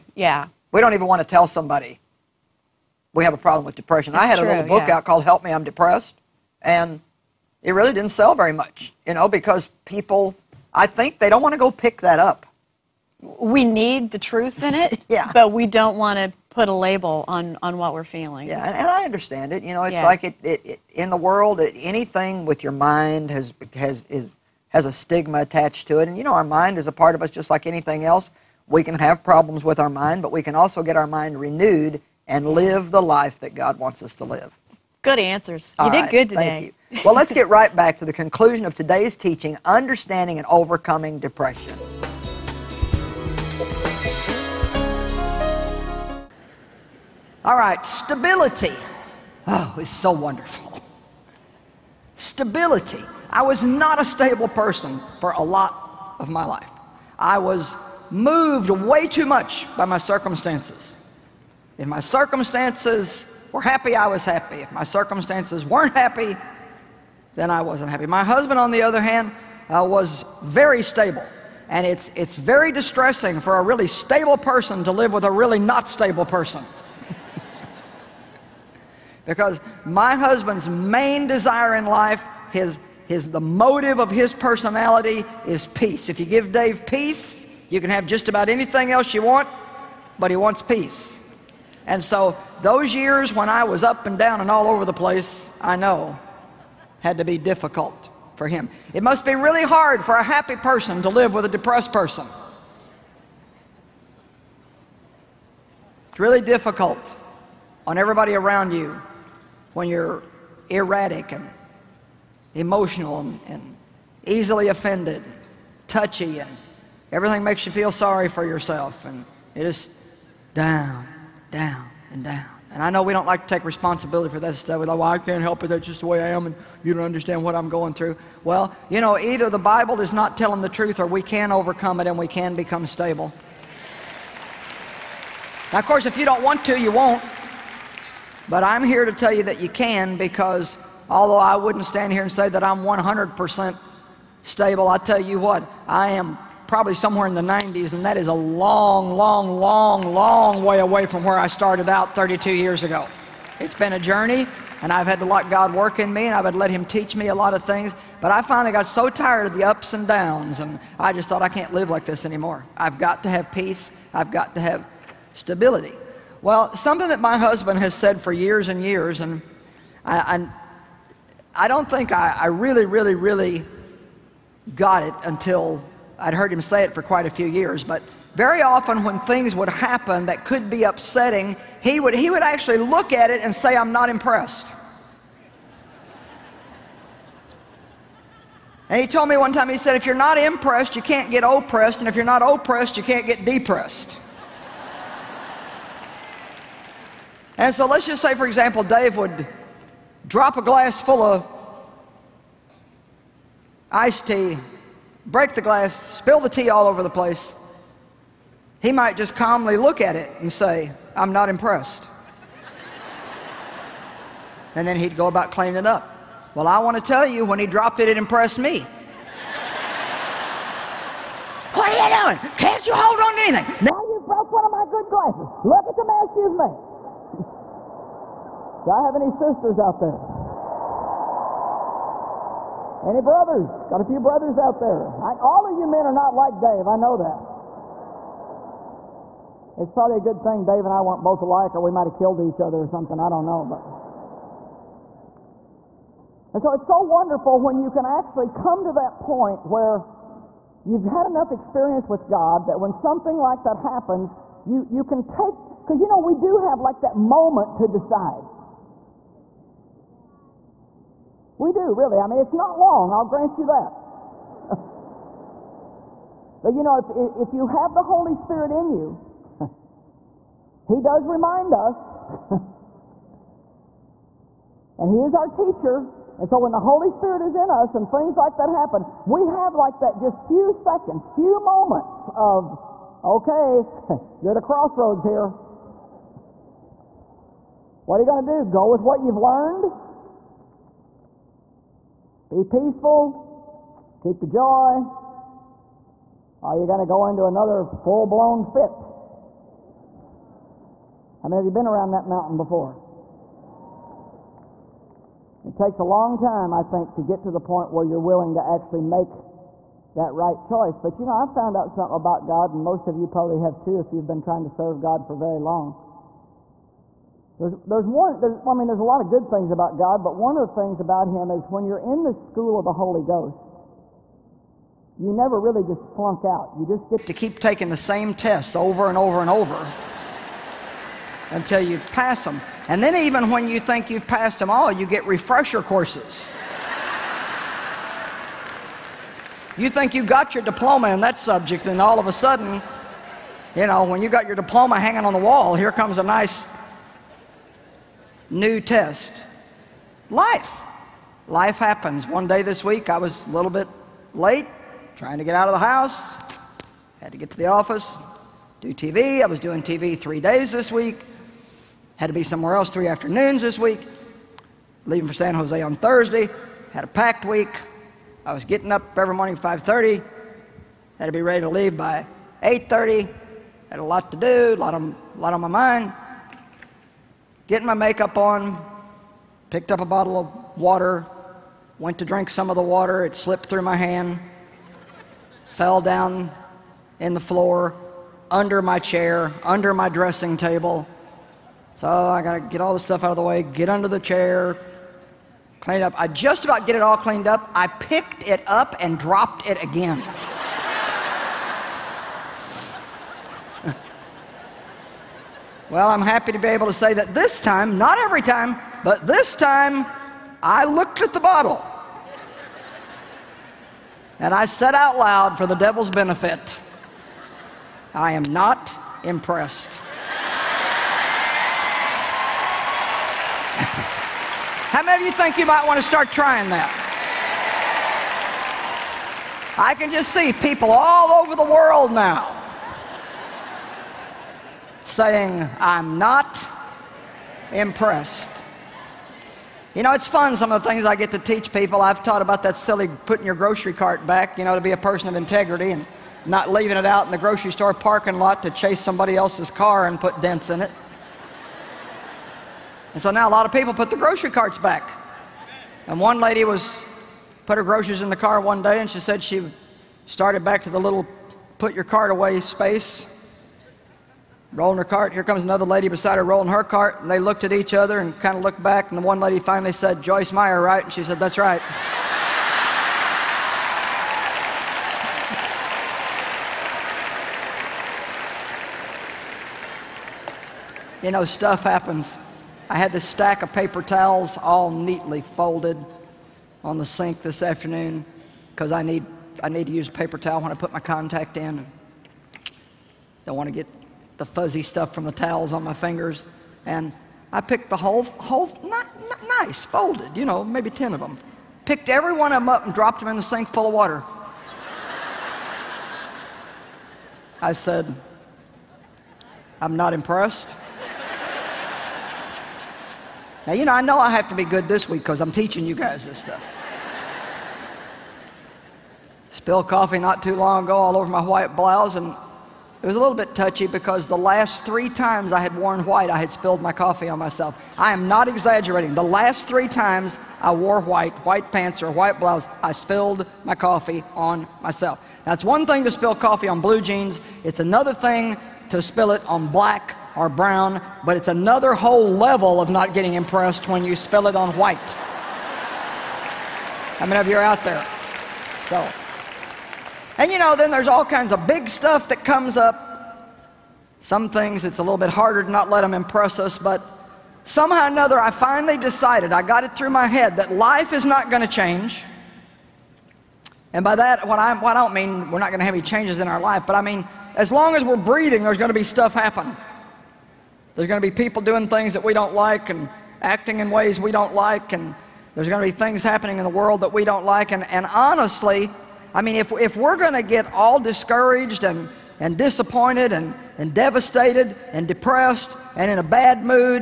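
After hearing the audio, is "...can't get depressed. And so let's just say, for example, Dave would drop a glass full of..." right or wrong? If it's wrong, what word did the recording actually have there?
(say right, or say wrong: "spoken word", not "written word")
right.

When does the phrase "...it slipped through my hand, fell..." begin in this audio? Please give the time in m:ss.
6:23.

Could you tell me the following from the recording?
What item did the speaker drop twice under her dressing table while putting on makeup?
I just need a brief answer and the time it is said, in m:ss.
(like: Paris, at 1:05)
A bottle of water, at 6:20.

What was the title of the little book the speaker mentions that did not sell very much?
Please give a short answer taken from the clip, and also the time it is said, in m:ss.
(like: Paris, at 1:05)
Help Me, I'm Depressed, at 0:05.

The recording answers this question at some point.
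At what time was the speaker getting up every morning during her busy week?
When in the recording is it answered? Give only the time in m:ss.
6:09.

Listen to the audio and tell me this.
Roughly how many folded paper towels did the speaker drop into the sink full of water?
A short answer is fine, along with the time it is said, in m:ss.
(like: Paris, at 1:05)
10, at 8:20.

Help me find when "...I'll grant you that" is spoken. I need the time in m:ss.
4:23.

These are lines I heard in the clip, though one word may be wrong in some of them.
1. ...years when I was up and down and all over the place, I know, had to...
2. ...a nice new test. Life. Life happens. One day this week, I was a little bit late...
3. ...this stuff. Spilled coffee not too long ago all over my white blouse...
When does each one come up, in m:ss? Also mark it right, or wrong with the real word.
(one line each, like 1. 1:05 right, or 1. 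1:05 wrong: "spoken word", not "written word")
1. 1:32 right
2. 5:46 right
3. 8:36 right.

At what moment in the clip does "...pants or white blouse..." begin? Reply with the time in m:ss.
8:51.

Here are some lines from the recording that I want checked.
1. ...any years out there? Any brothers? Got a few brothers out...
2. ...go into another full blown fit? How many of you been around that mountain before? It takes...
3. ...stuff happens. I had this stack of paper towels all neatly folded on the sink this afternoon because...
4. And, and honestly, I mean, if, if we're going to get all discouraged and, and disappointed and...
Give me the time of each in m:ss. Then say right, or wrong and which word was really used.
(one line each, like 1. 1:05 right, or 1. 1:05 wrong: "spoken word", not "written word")
1. 3:49 wrong: "sisters", not "years"
2. 4:57 right
3. 8:01 right
4. 9:37 right.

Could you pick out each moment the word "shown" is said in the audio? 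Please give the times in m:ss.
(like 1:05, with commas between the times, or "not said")
not said.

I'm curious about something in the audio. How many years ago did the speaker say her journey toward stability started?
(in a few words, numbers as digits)
32.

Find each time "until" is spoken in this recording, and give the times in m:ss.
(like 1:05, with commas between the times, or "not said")
2:55, 5:31.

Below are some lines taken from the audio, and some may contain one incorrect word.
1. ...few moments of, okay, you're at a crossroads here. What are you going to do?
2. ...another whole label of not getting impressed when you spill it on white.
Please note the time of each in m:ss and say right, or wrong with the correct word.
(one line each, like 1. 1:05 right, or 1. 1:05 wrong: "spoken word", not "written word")
1. 4:41 right
2. 9:01 wrong: "level", not "label".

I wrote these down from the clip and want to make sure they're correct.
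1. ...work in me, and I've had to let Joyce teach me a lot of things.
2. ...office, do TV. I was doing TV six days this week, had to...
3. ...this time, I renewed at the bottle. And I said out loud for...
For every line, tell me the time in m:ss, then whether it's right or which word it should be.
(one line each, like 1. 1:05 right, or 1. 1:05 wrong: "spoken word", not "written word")
1. 2:35 wrong: "Him", not "Joyce"
2. 5:57 wrong: "three", not "six"
3. 6:49 wrong: "looked", not "renewed".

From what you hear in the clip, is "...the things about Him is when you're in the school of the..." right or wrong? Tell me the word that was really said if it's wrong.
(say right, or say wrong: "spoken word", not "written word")
right.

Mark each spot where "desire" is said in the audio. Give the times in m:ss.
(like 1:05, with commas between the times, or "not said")
1:21.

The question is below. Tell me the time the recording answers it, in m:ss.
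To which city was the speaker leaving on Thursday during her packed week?
6:05.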